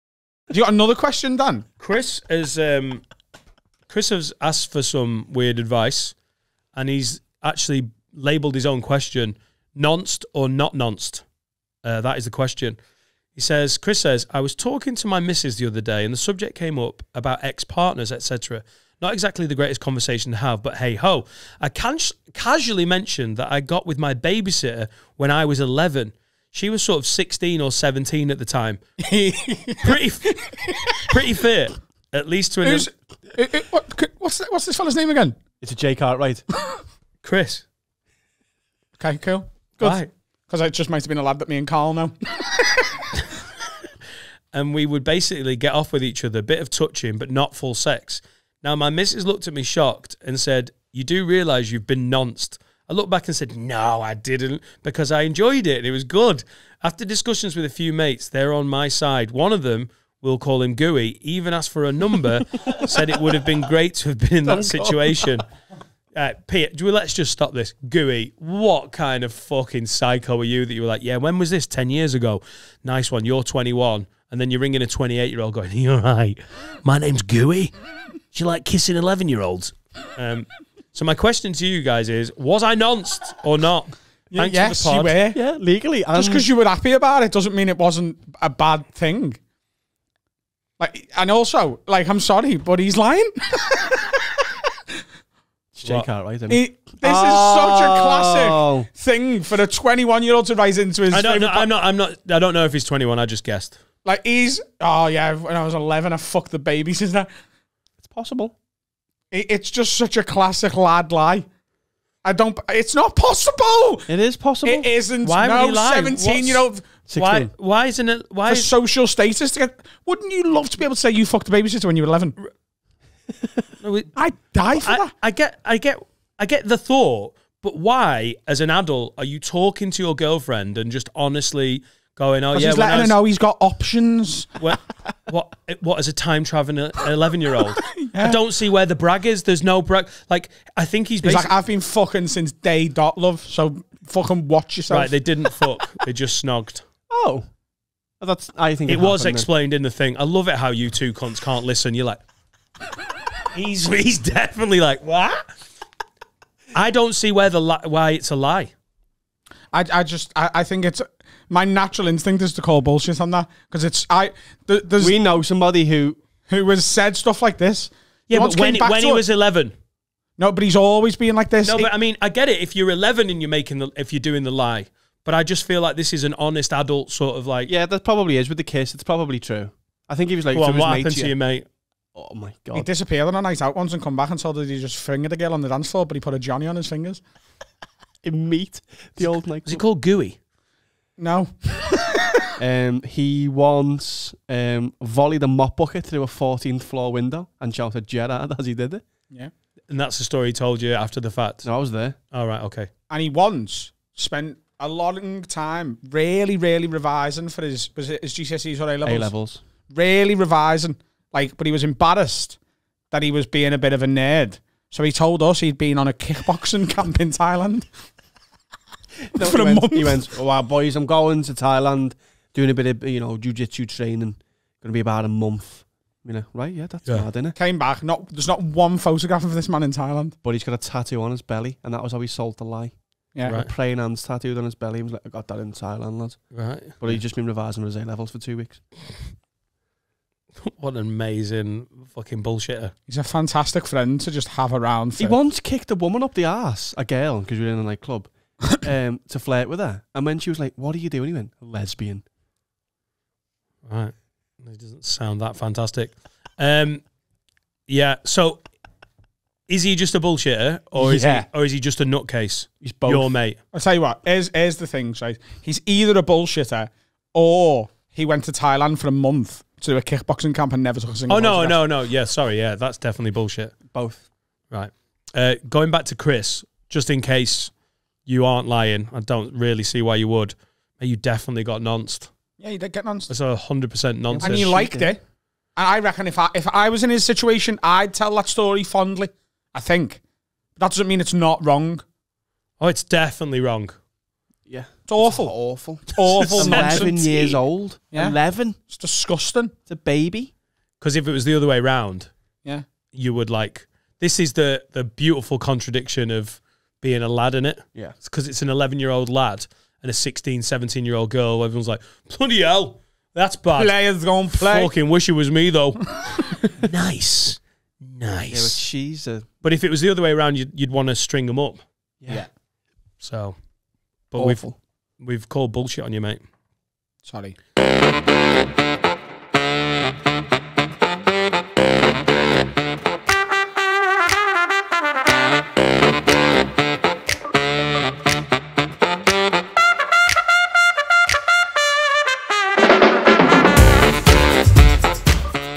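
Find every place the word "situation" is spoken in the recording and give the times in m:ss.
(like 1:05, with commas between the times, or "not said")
1:04, 4:47.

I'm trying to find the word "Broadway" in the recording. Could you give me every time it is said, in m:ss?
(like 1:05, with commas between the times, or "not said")
not said.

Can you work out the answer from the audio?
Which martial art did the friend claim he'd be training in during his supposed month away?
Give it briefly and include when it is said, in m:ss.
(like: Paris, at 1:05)
Jujitsu, at 3:43.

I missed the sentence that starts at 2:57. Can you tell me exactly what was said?
Yeah, that probably is with the kiss.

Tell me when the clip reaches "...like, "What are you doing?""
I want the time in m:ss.
4:10.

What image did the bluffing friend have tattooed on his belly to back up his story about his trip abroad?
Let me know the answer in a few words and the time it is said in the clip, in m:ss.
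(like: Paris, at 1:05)
Praying hands, at 3:53.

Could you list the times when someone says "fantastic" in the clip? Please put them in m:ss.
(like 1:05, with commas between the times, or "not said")
4:03, 4:15.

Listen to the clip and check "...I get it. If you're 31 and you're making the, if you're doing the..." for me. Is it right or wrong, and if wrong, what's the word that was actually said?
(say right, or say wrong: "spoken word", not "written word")
wrong: "11", not "31".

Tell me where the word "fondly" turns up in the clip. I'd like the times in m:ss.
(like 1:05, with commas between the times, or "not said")
4:48.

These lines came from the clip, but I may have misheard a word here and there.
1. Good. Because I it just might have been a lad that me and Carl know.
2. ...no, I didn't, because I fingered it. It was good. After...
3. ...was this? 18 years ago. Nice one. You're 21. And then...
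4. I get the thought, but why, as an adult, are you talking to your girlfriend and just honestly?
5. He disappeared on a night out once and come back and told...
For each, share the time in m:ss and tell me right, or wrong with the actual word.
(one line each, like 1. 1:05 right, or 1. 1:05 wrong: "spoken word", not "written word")
1. 0:39 right
2. 0:53 wrong: "enjoyed", not "fingered"
3. 1:11 wrong: "10", not "18"
4. 2:06 right
5. 3:02 right.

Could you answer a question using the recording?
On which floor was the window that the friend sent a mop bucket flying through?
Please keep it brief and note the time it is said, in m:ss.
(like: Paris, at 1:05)
14th, at 3:16.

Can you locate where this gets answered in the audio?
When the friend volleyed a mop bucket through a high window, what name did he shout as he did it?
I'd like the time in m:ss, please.
3:18.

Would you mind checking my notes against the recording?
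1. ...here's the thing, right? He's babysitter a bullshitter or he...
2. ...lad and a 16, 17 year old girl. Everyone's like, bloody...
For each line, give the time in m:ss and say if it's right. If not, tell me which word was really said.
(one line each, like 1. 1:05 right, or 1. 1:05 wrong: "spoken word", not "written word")
1. 4:24 wrong: "either", not "babysitter"
2. 5:09 right.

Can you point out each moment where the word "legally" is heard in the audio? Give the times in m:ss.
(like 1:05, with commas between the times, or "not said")
1:25.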